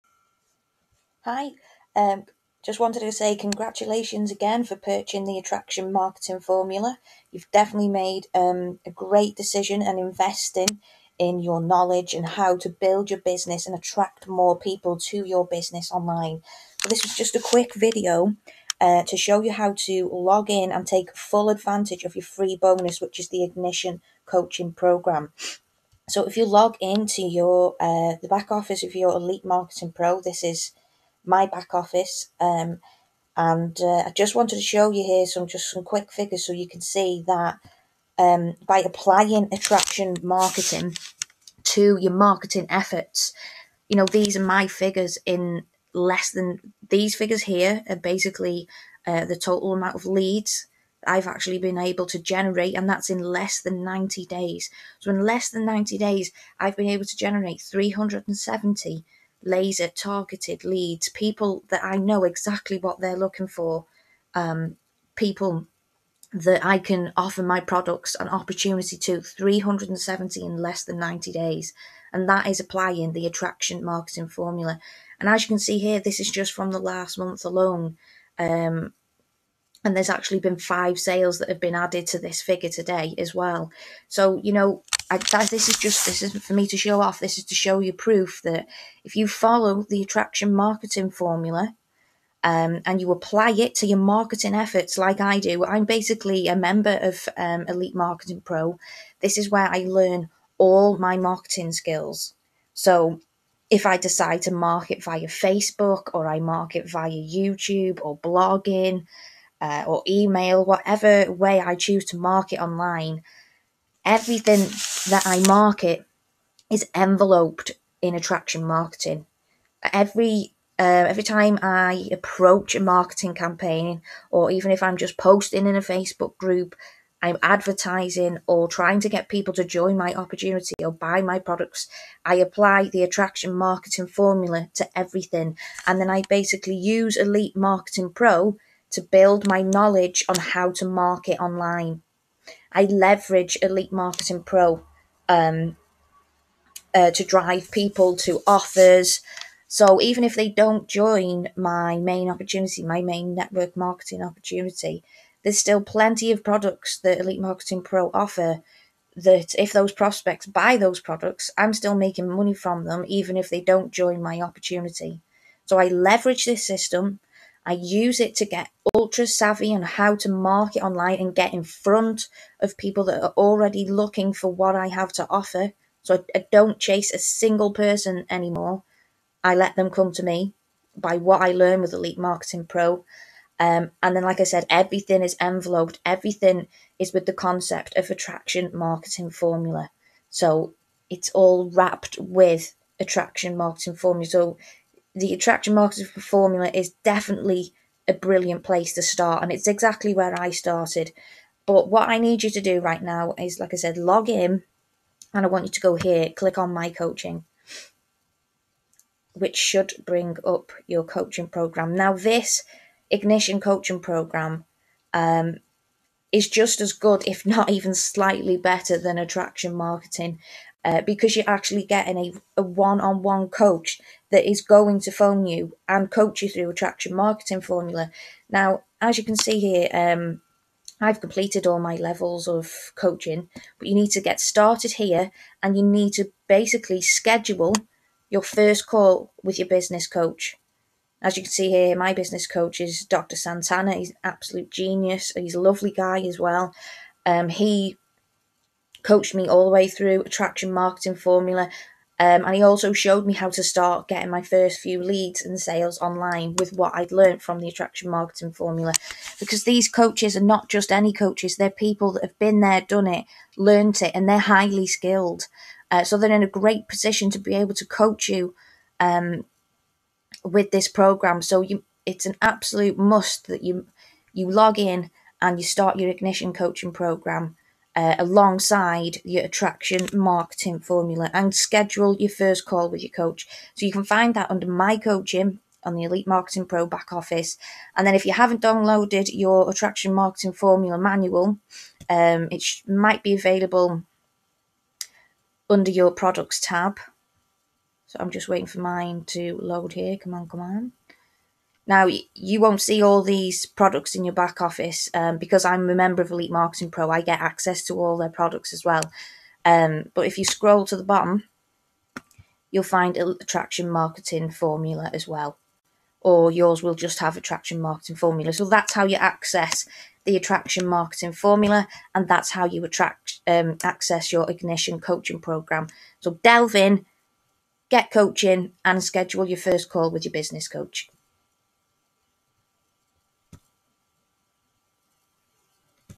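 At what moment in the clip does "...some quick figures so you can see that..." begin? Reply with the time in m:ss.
0:35.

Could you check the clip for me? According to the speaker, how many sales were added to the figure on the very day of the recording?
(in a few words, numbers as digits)
5.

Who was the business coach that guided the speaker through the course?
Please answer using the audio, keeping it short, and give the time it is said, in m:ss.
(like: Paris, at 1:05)
Dr. Santana, at 4:03.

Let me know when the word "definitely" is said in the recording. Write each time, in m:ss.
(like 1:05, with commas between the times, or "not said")
0:07, 3:17.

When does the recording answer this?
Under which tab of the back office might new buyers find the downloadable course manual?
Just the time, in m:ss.
4:56.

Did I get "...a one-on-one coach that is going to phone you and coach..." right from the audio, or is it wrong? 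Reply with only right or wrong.
right.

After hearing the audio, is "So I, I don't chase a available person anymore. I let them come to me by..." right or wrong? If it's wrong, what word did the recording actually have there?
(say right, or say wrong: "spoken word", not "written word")
wrong: "single", not "available".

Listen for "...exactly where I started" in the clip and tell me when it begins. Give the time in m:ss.
3:19.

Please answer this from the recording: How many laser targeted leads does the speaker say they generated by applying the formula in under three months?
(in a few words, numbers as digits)
370.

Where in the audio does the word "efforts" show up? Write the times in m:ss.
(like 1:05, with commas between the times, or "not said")
0:42, 1:34.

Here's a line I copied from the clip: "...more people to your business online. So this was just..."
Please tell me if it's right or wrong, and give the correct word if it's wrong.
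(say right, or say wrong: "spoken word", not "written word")
right.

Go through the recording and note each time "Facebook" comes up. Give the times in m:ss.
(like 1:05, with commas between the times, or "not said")
1:45, 2:05.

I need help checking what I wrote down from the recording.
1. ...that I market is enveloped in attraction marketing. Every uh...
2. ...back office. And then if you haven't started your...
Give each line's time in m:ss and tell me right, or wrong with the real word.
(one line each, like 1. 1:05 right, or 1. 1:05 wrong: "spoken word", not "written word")
1. 1:55 right
2. 4:46 wrong: "downloaded", not "started".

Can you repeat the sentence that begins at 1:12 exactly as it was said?
And that is applying the attraction marketing formula.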